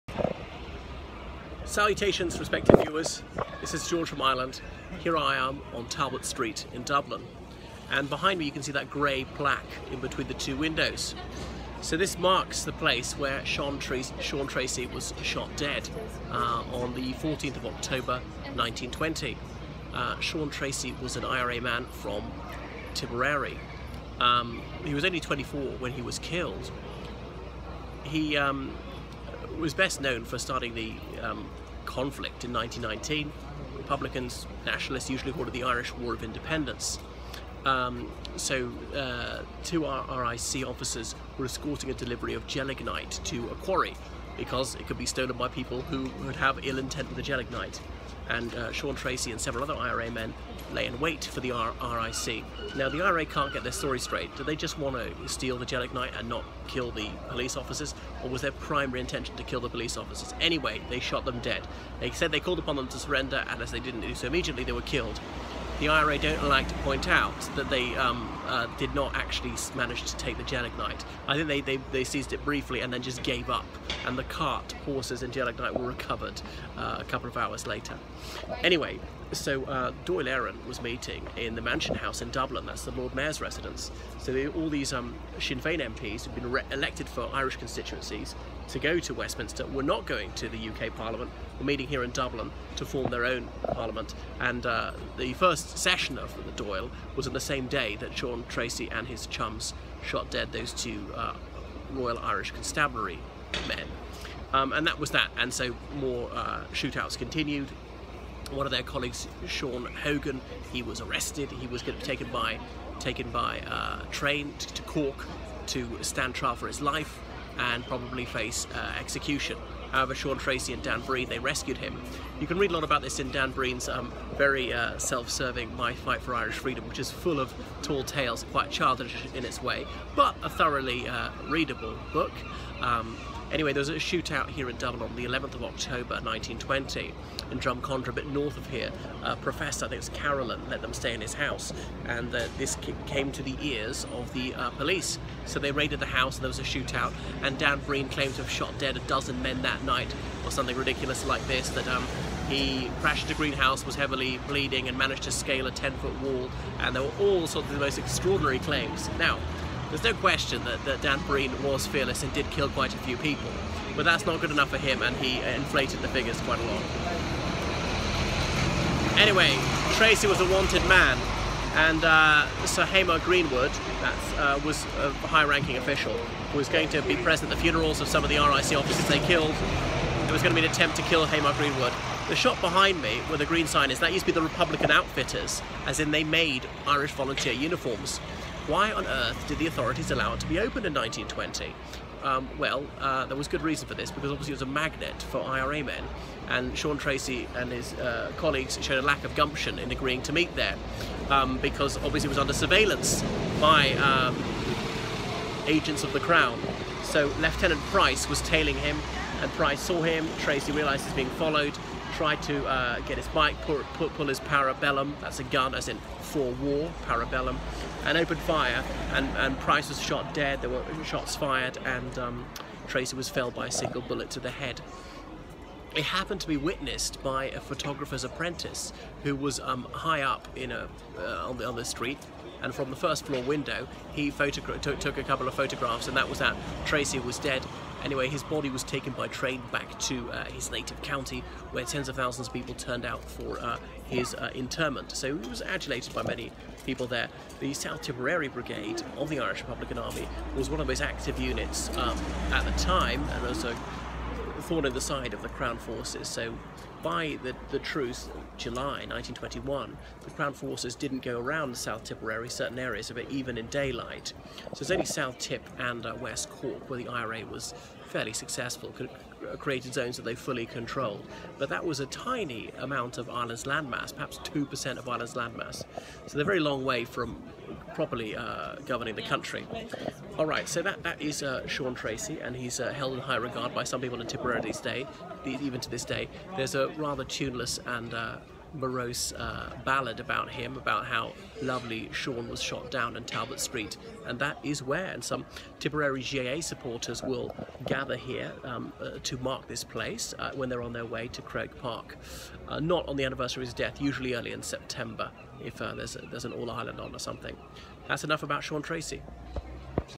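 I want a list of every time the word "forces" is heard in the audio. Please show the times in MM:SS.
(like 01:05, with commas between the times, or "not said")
04:15, 04:20.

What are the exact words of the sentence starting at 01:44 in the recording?
Um, and that was that, and so more uh, shootouts continued.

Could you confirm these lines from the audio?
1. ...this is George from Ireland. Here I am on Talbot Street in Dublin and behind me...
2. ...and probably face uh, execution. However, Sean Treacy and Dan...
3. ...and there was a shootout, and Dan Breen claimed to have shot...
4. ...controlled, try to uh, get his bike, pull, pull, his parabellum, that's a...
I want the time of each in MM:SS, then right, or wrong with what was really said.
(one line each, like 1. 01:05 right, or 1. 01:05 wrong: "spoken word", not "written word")
1. 00:03 right
2. 01:57 right
3. 02:26 right
4. 03:31 wrong: "followed", not "controlled".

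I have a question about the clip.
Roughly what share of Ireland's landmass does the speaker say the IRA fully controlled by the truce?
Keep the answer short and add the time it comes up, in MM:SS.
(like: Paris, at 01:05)
2%, at 04:34.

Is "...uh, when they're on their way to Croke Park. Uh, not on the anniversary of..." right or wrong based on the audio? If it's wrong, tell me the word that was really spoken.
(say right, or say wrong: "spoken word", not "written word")
right.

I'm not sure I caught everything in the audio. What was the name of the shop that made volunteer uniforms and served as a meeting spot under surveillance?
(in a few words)
Republican Outfitters.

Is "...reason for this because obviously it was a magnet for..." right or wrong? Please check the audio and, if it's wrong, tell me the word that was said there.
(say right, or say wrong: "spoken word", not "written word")
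right.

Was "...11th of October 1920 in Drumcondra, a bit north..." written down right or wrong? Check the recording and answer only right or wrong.
right.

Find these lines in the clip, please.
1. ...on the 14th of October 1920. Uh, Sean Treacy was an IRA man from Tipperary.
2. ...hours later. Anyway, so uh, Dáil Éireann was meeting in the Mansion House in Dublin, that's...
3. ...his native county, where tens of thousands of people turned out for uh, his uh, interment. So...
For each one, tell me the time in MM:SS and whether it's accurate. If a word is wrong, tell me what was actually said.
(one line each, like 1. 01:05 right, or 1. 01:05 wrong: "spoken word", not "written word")
1. 00:16 right
2. 01:17 right
3. 04:00 right.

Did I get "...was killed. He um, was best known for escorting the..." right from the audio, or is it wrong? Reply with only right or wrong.
wrong.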